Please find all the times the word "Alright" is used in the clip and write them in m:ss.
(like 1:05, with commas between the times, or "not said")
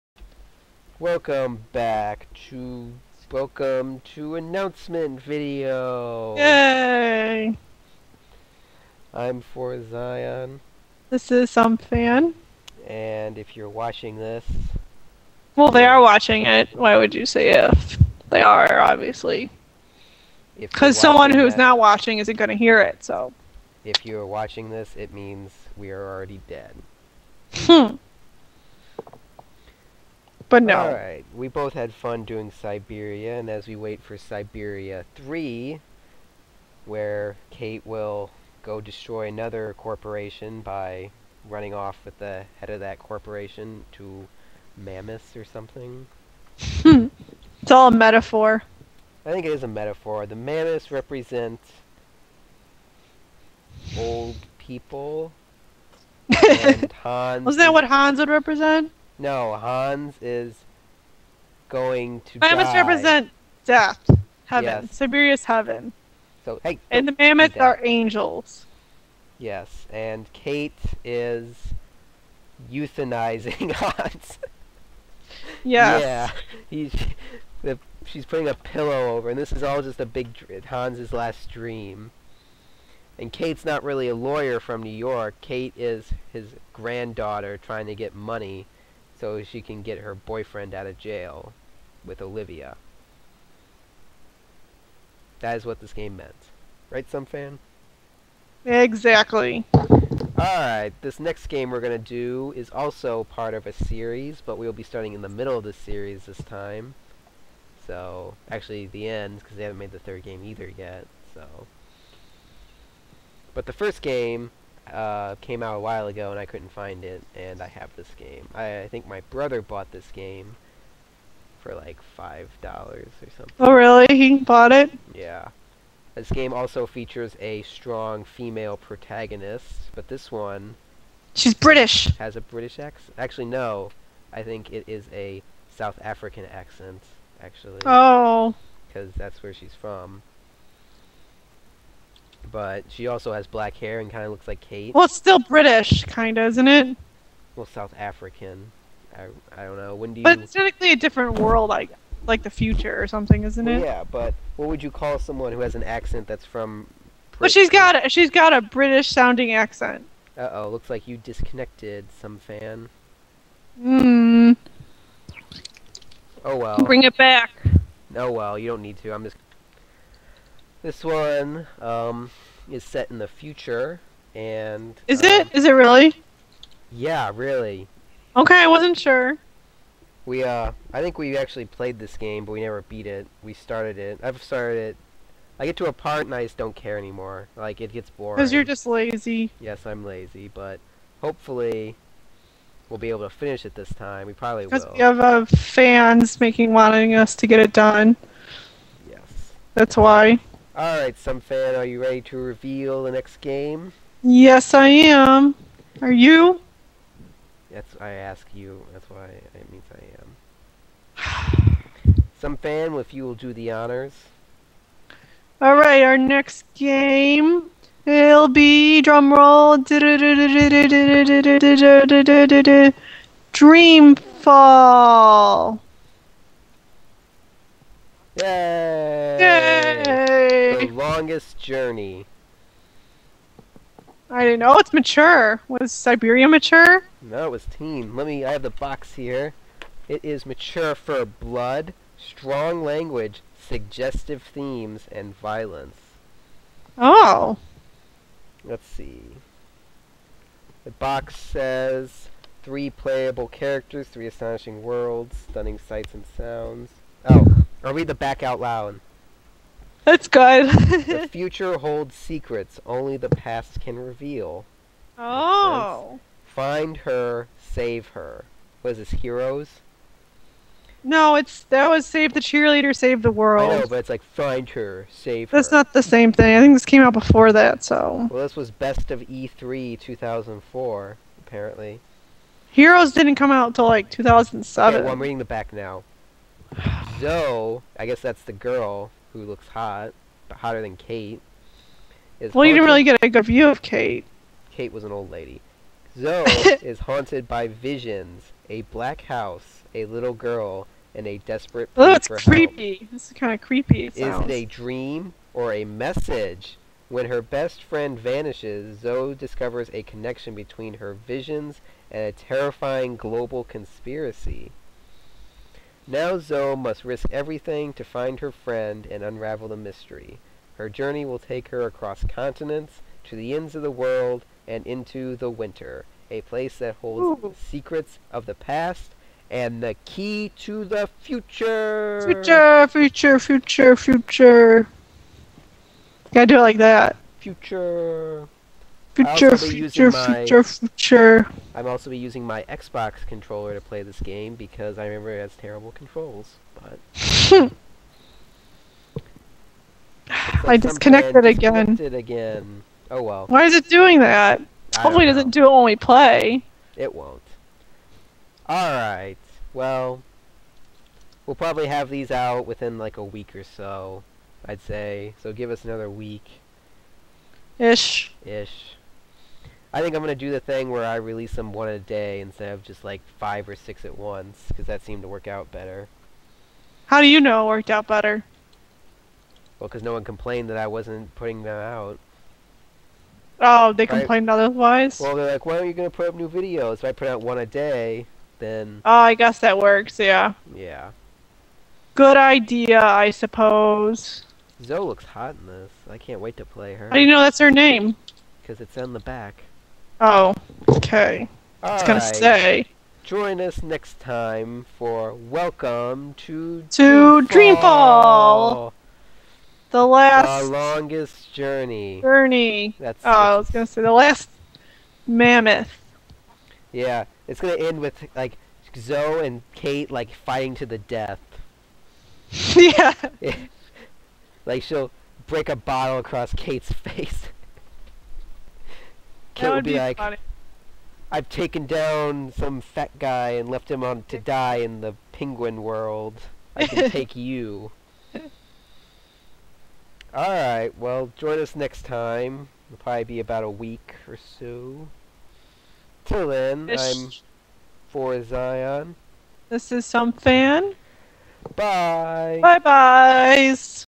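1:40, 3:20, 3:35.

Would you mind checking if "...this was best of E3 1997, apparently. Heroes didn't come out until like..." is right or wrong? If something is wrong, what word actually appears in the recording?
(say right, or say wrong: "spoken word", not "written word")
wrong: "2004", not "1997".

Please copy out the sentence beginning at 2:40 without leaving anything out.
Uh oh, looks like you disconnected some fan.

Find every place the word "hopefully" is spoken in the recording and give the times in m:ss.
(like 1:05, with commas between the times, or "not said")
3:11, 5:55.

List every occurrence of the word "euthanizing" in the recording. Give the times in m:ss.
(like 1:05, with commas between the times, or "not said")
1:12.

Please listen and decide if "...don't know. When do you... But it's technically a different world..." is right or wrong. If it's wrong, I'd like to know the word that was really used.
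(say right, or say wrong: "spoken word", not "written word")
right.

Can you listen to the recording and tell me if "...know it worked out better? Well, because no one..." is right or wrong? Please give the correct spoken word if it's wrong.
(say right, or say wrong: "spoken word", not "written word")
right.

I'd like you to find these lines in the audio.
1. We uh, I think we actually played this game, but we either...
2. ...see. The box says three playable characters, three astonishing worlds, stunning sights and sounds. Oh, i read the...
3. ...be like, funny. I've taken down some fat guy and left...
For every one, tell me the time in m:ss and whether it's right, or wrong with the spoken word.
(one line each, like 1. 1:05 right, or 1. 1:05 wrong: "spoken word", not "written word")
1. 3:00 wrong: "never", not "either"
2. 4:08 right
3. 7:09 right.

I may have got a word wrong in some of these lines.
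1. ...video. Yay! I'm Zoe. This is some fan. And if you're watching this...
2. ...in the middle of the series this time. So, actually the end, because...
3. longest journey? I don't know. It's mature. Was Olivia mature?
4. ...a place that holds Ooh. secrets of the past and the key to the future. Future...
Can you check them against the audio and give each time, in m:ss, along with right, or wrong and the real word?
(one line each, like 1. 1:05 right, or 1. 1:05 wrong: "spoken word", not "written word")
1. 0:05 wrong: "Forzion", not "Zoe"
2. 1:45 right
3. 3:51 wrong: "Syberia", not "Olivia"
4. 5:26 right.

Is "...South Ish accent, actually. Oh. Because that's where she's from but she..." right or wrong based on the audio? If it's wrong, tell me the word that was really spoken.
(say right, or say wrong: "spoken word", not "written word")
wrong: "African", not "Ish".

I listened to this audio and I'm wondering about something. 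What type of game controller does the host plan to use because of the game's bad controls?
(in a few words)
Xbox controller.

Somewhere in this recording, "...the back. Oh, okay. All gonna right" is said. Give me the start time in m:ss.
6:39.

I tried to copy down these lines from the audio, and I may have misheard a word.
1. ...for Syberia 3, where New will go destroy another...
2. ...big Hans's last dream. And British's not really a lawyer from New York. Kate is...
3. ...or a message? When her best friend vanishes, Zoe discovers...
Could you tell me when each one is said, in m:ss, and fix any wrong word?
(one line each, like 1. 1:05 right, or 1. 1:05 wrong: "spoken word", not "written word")
1. 0:34 wrong: "Kate", not "New"
2. 1:20 wrong: "Kate", not "British"
3. 5:05 right.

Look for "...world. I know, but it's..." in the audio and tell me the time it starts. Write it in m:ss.
4:33.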